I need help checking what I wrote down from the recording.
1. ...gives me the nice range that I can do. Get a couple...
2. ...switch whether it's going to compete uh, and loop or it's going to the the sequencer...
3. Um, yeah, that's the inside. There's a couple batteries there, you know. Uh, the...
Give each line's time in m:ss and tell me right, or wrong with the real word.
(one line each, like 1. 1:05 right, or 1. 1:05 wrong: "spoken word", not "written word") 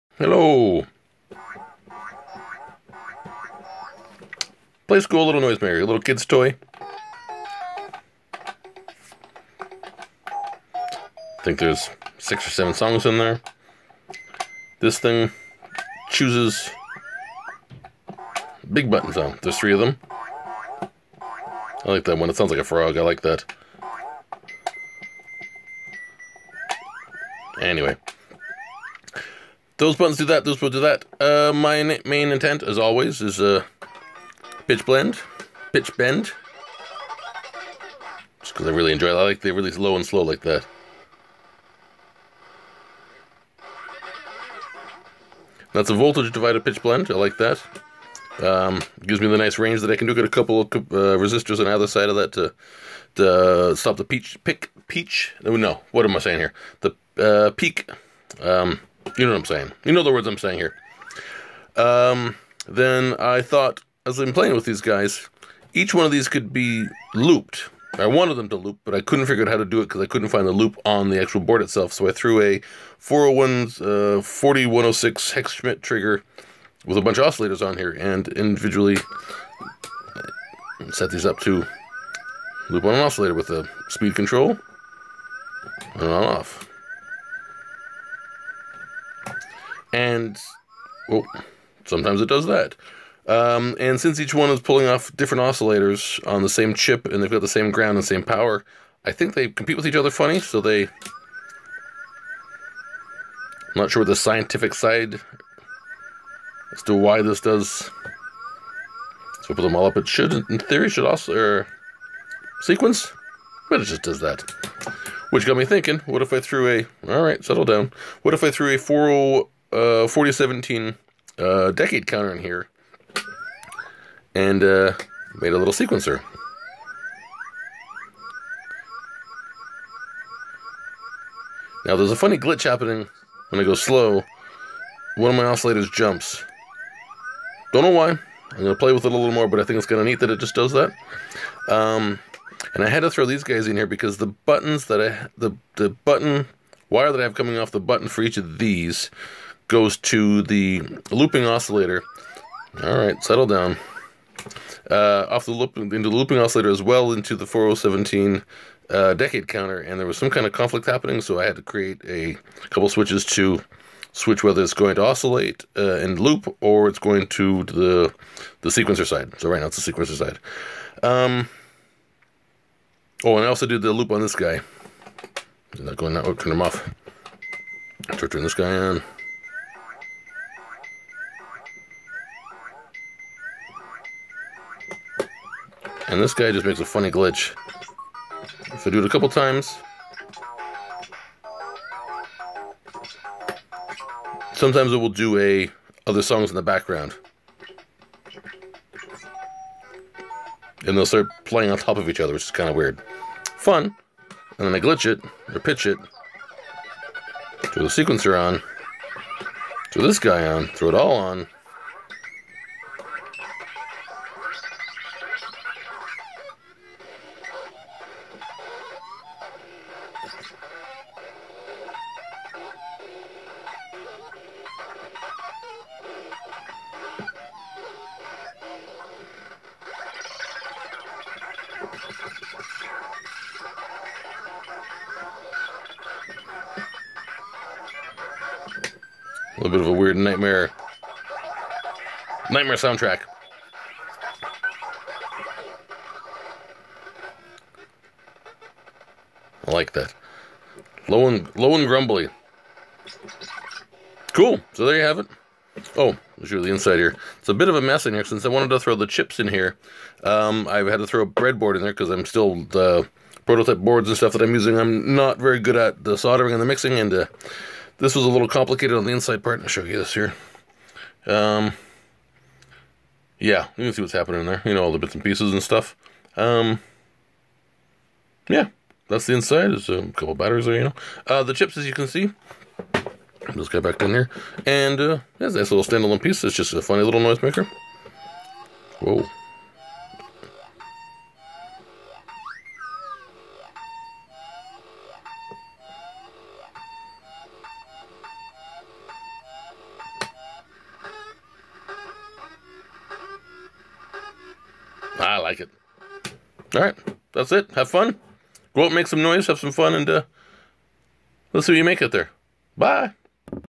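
1. 0:49 right
2. 2:44 wrong: "oscillate", not "compete"
3. 4:36 right.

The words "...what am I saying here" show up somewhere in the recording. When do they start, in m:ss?
0:55.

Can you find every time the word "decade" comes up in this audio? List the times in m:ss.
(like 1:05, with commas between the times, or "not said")
2:01, 2:39.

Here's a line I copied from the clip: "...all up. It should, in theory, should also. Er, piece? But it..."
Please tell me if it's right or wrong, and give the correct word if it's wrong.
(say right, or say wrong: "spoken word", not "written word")
wrong: "sequence", not "piece".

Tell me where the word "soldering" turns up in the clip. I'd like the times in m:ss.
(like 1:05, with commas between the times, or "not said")
4:26.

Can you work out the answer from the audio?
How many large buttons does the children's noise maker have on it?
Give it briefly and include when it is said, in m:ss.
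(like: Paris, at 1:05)
3, at 0:19.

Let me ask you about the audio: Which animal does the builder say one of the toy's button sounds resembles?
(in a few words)
A frog.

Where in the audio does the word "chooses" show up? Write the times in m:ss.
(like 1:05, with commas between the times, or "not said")
0:16.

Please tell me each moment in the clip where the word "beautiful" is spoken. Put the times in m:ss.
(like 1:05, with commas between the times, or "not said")
not said.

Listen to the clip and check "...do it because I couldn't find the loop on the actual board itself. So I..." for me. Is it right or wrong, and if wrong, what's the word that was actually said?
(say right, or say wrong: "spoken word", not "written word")
right.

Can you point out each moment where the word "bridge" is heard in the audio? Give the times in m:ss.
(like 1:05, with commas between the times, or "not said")
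not said.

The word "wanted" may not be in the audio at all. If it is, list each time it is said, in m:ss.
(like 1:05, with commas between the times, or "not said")
1:08, 4:18.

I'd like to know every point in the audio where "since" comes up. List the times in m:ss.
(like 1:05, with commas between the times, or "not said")
1:33, 4:18.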